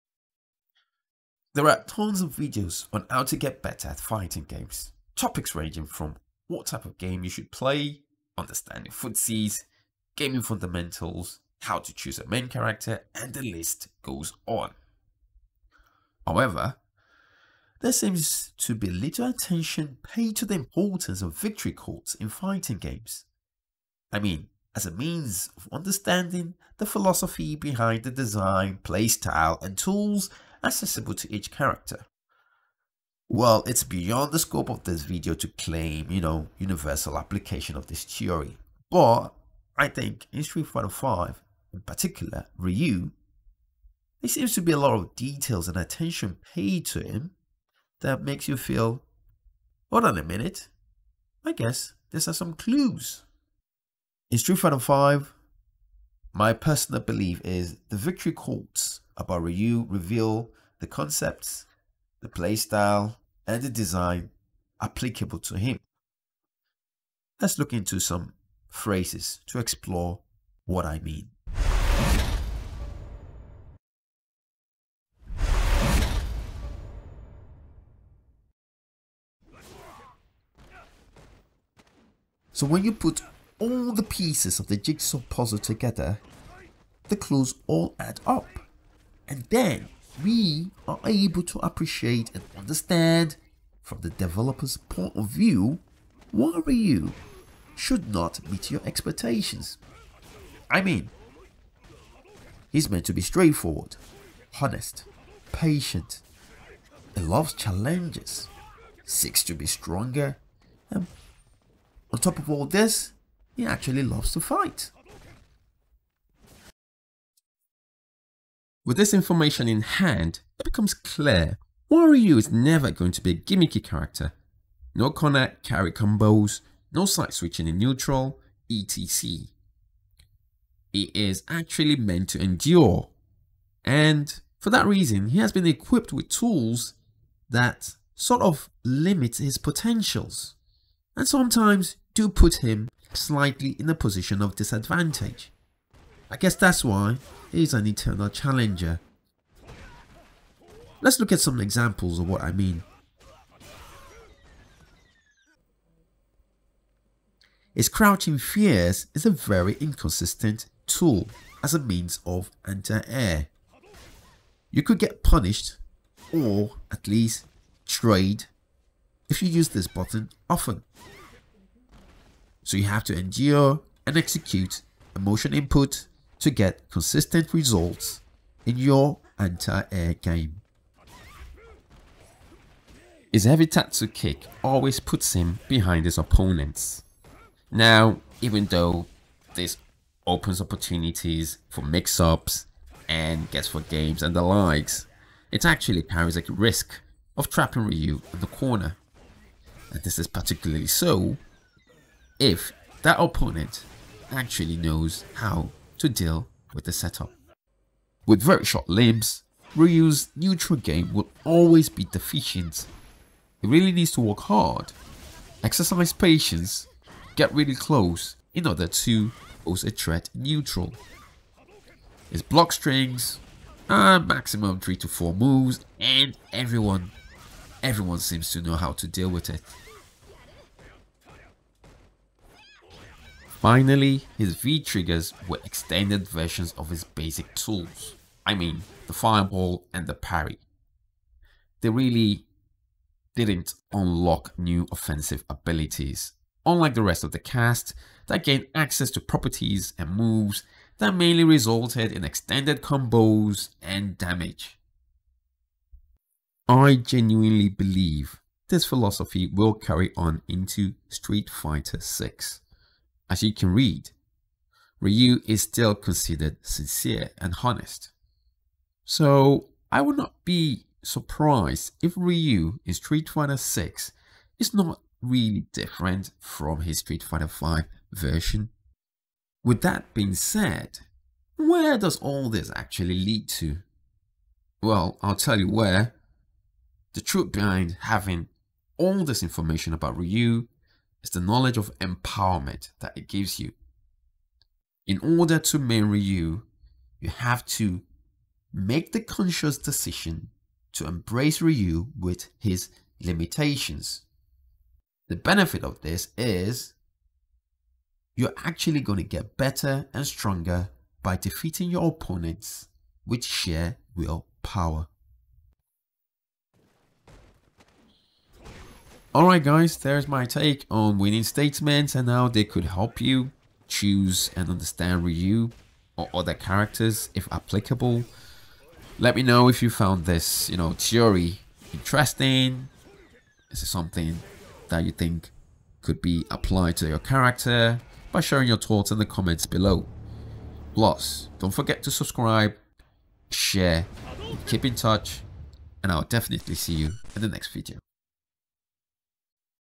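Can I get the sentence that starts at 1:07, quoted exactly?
Let's look into some phrases to explore what I mean.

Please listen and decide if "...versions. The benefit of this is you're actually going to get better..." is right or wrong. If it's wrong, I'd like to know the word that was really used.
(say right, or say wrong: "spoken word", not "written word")
wrong: "limitations", not "versions".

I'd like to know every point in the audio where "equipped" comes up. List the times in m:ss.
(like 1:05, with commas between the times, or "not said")
2:15.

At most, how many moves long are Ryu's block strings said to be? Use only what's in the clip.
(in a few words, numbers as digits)
3 to 4.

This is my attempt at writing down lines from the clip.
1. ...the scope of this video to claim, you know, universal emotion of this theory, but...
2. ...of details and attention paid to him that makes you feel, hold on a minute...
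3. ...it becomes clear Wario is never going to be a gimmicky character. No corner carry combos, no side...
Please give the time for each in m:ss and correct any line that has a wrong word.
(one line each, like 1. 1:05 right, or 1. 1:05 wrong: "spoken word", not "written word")
1. 0:34 wrong: "application", not "emotion"
2. 0:44 right
3. 2:00 right.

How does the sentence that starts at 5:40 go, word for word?
Plus, don't forget to subscribe, share, keep in touch, and I'll definitely see you in the next video.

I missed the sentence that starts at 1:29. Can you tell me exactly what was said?
And then we are able to appreciate and understand from the developer's point of view why Ryu should not meet your expectations.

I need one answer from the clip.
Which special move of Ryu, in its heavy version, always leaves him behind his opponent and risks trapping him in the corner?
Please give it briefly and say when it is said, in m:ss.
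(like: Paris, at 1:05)
tatsu kick, at 3:03.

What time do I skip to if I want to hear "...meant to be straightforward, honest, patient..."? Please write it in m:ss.
1:42.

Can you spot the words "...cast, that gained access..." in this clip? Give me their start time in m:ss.
4:07.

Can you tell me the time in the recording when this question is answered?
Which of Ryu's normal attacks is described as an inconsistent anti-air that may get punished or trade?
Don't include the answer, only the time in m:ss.
2:37.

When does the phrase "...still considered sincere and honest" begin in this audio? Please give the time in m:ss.
4:25.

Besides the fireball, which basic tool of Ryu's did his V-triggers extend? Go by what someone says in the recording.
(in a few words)
the parry.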